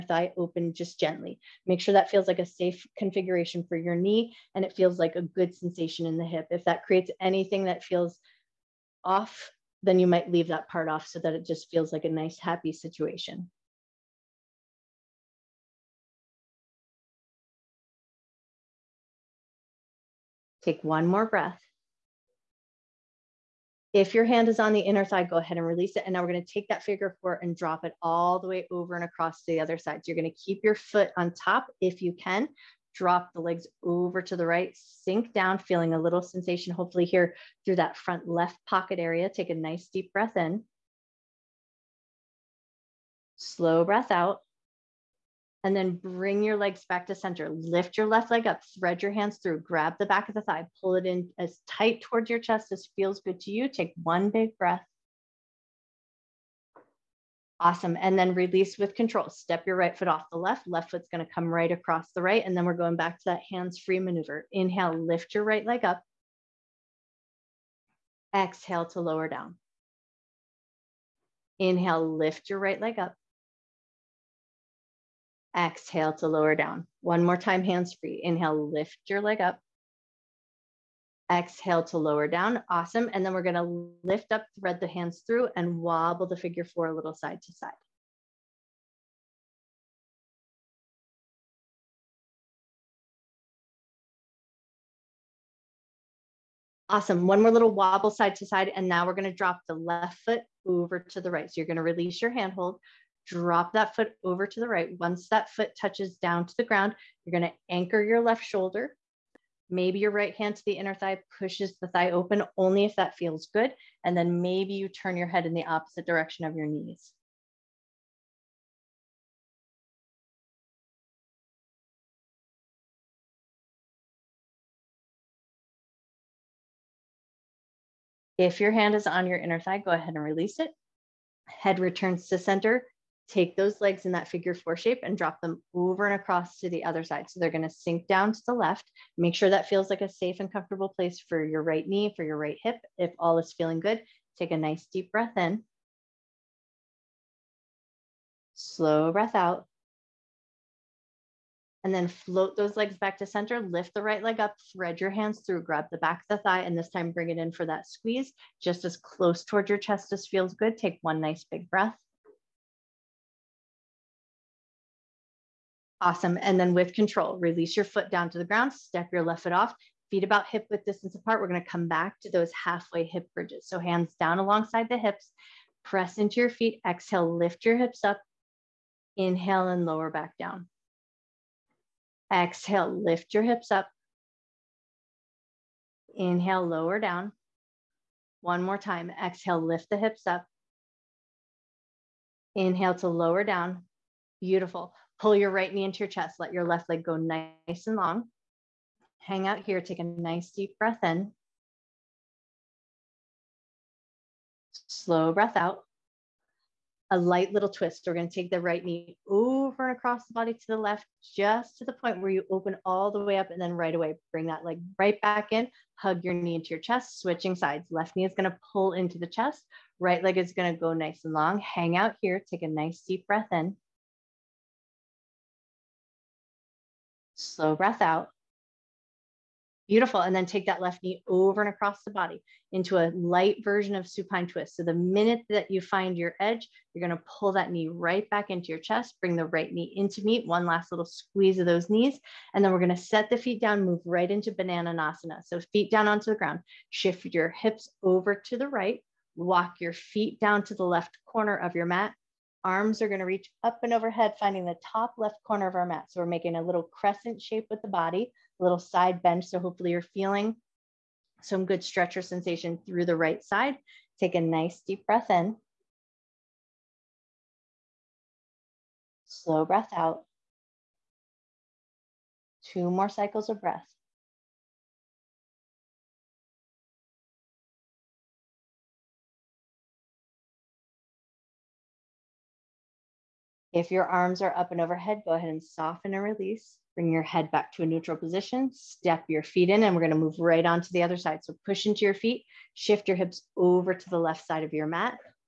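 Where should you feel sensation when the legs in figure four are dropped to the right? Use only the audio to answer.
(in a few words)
front left pocket.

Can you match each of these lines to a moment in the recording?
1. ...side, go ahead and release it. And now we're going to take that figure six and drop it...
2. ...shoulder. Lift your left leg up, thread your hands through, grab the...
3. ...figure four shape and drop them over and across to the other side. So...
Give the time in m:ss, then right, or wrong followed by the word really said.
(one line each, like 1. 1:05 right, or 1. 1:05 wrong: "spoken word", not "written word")
1. 0:25 wrong: "four", not "six"
2. 0:47 wrong: "center", not "shoulder"
3. 2:14 right.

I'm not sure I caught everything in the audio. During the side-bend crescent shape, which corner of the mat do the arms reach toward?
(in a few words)
top left corner.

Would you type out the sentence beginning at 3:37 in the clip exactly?
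Left knee is going to pull into the chest.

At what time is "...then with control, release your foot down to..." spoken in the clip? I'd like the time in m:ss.
2:46.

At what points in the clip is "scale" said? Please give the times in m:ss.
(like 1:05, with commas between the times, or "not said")
not said.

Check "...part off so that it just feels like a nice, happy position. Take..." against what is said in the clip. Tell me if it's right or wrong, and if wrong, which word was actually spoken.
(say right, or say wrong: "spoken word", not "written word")
wrong: "situation", not "position".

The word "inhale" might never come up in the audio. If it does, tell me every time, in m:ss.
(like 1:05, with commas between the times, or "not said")
1:04, 1:11, 1:18, 2:59, 3:06, 3:12.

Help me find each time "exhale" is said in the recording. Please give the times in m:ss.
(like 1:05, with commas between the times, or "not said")
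1:08, 1:15, 1:21, 2:56, 3:02, 3:09.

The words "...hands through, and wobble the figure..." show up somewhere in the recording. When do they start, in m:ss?
1:24.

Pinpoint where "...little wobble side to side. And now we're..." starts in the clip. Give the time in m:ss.
1:37.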